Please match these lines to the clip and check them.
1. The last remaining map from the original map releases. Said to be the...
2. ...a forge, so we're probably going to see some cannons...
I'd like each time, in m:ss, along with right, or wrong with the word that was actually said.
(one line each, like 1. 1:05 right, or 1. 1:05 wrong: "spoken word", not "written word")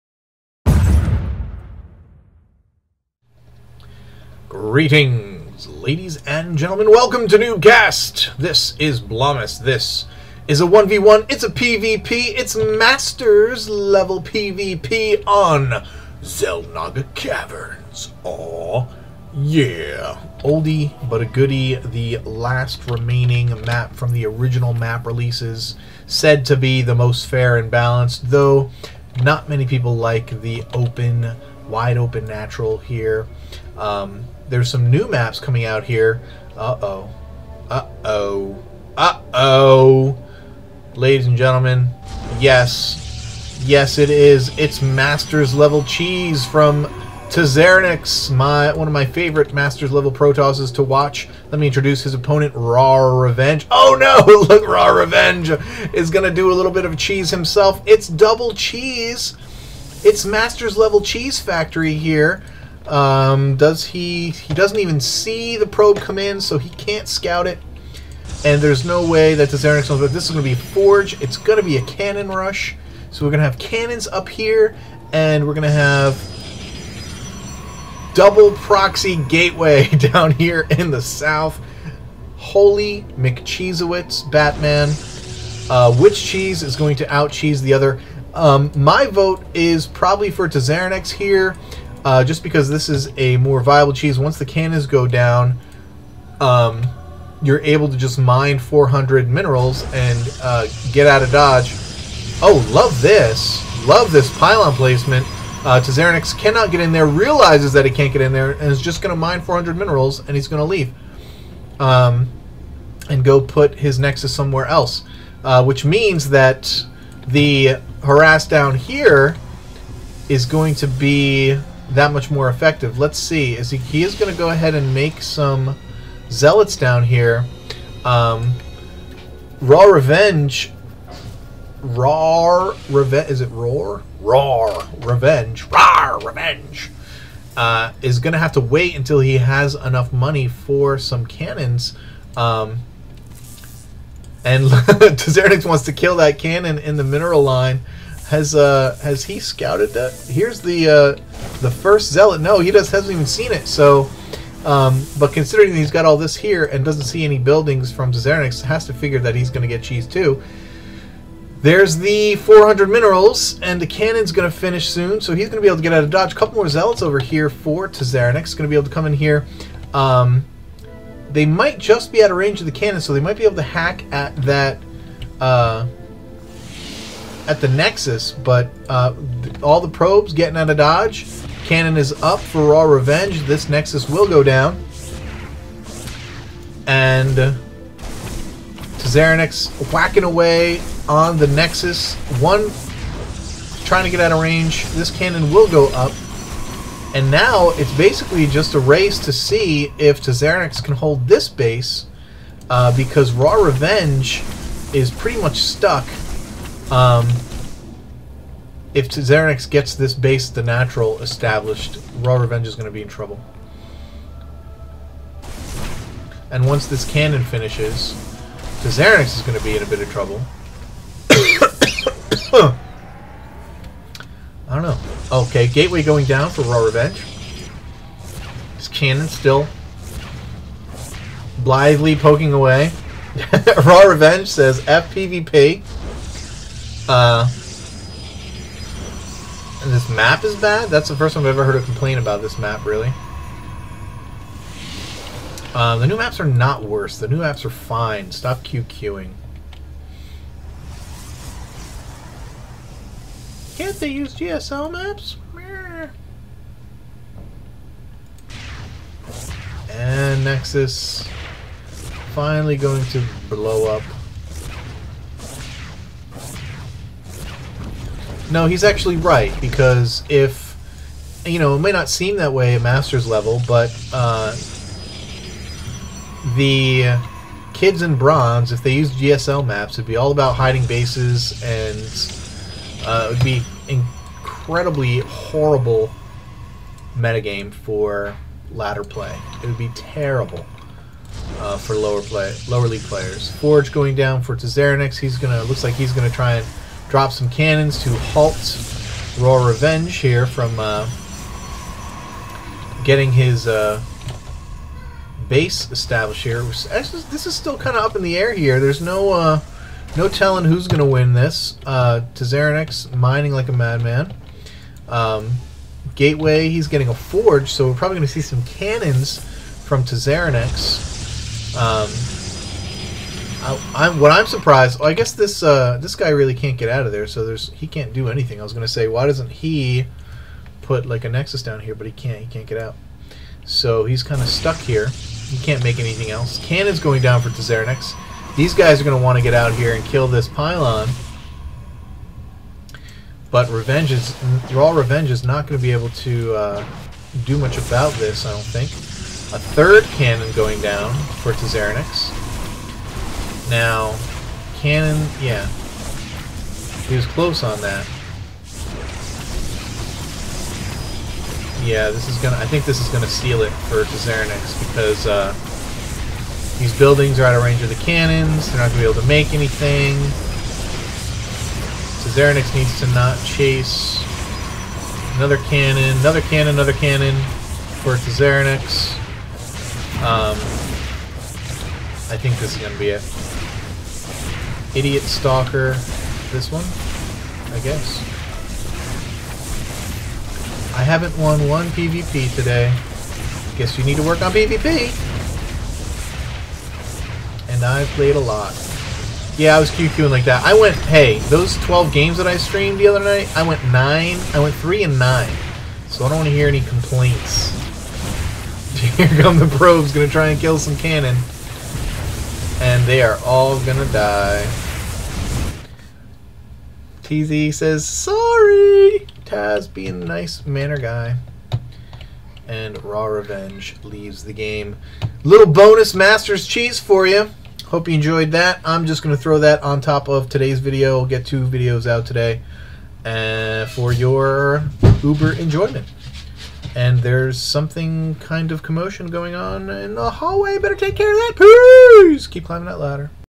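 1. 0:21 right
2. 5:17 right.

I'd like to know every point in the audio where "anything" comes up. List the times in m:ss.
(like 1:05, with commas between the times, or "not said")
5:28, 5:35, 6:09.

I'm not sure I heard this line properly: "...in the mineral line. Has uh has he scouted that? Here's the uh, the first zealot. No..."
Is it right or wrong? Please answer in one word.
right.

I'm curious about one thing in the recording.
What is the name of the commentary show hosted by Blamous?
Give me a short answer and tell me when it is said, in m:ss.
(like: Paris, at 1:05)
NuubCast, at 0:07.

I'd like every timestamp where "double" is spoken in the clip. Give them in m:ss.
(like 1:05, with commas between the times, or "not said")
0:58, 1:18.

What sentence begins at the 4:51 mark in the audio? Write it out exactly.
Uh, for lower play, lower league players.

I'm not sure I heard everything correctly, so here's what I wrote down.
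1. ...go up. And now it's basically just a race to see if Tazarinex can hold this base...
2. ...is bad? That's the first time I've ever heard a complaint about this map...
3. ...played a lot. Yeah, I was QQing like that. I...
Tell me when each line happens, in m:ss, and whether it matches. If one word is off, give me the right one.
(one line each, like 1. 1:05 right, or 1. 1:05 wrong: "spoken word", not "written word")
1. 3:15 right
2. 4:00 right
3. 6:38 right.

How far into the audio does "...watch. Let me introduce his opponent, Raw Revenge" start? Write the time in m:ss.
0:50.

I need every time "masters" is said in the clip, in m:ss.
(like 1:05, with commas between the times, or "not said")
0:12, 0:44, 0:49, 1:00, 4:32, 7:06.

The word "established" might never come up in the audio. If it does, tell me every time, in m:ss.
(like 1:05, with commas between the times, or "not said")
3:31, 5:05.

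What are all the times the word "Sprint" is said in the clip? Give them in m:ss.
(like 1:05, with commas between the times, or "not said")
not said.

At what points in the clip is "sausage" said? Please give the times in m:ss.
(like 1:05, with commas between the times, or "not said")
not said.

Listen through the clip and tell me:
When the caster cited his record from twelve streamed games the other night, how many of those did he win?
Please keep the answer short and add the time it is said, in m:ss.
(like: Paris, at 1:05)
3, at 6:44.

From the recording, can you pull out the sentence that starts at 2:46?
A couple more zealots over here for Tazarnix.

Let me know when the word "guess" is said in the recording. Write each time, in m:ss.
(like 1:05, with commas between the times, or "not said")
5:25, 6:27, 6:33.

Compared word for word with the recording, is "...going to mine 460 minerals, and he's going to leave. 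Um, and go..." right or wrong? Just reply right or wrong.
wrong.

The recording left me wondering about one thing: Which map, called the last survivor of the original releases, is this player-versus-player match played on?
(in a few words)
Xel'Naga Caverns.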